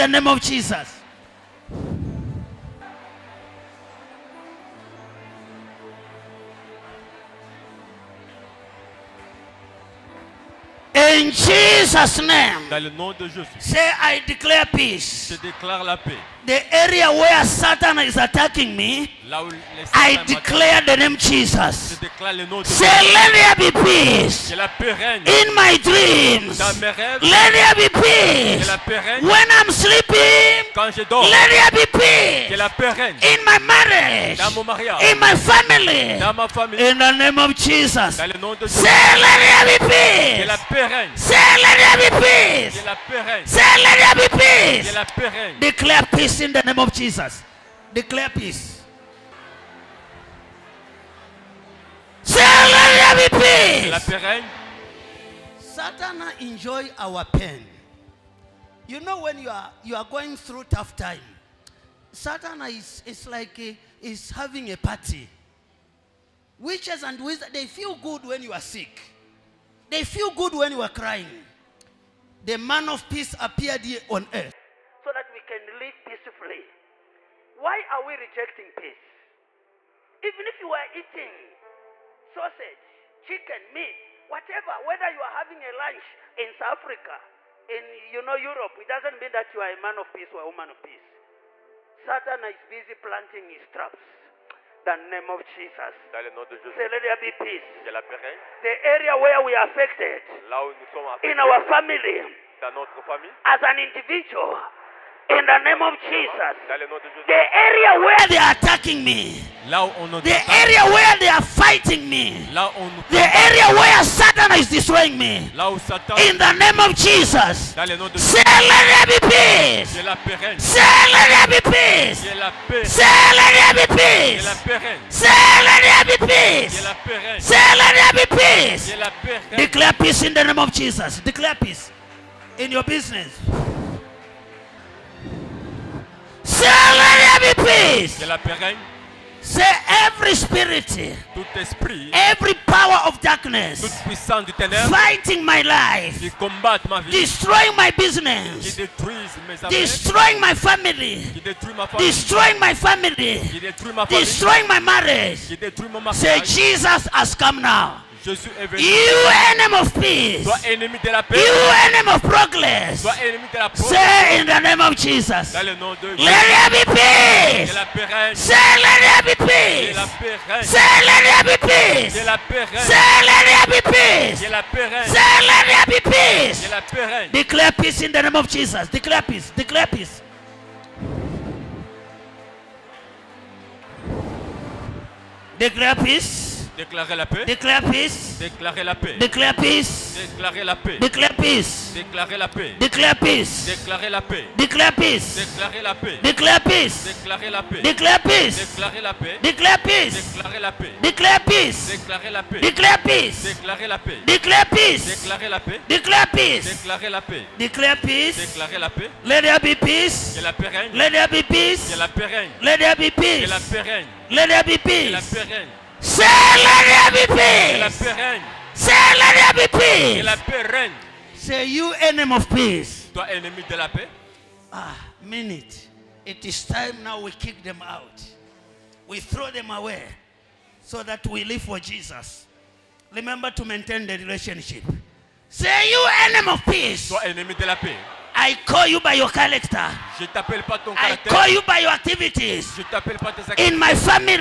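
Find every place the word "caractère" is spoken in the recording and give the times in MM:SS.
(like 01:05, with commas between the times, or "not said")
04:00.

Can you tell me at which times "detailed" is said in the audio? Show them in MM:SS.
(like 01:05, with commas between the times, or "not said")
not said.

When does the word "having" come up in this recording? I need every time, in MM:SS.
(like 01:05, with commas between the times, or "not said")
01:04, 01:25.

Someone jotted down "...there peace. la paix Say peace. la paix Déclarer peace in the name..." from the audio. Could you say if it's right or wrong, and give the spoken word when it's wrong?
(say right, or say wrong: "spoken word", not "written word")
wrong: "Declare", not "Déclarer".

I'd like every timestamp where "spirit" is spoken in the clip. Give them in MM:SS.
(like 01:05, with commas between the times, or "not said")
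02:20.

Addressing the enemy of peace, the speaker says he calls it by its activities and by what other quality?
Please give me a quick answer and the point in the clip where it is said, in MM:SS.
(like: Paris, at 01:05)
character, at 03:59.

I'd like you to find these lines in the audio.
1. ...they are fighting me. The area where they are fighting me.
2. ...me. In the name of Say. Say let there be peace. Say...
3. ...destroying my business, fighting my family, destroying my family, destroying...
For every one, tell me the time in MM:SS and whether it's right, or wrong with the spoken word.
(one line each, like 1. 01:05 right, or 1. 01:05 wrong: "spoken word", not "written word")
1. 01:48 wrong: "attacking", not "fighting"
2. 01:55 wrong: "Jesus", not "Say"
3. 02:27 wrong: "destroying", not "fighting".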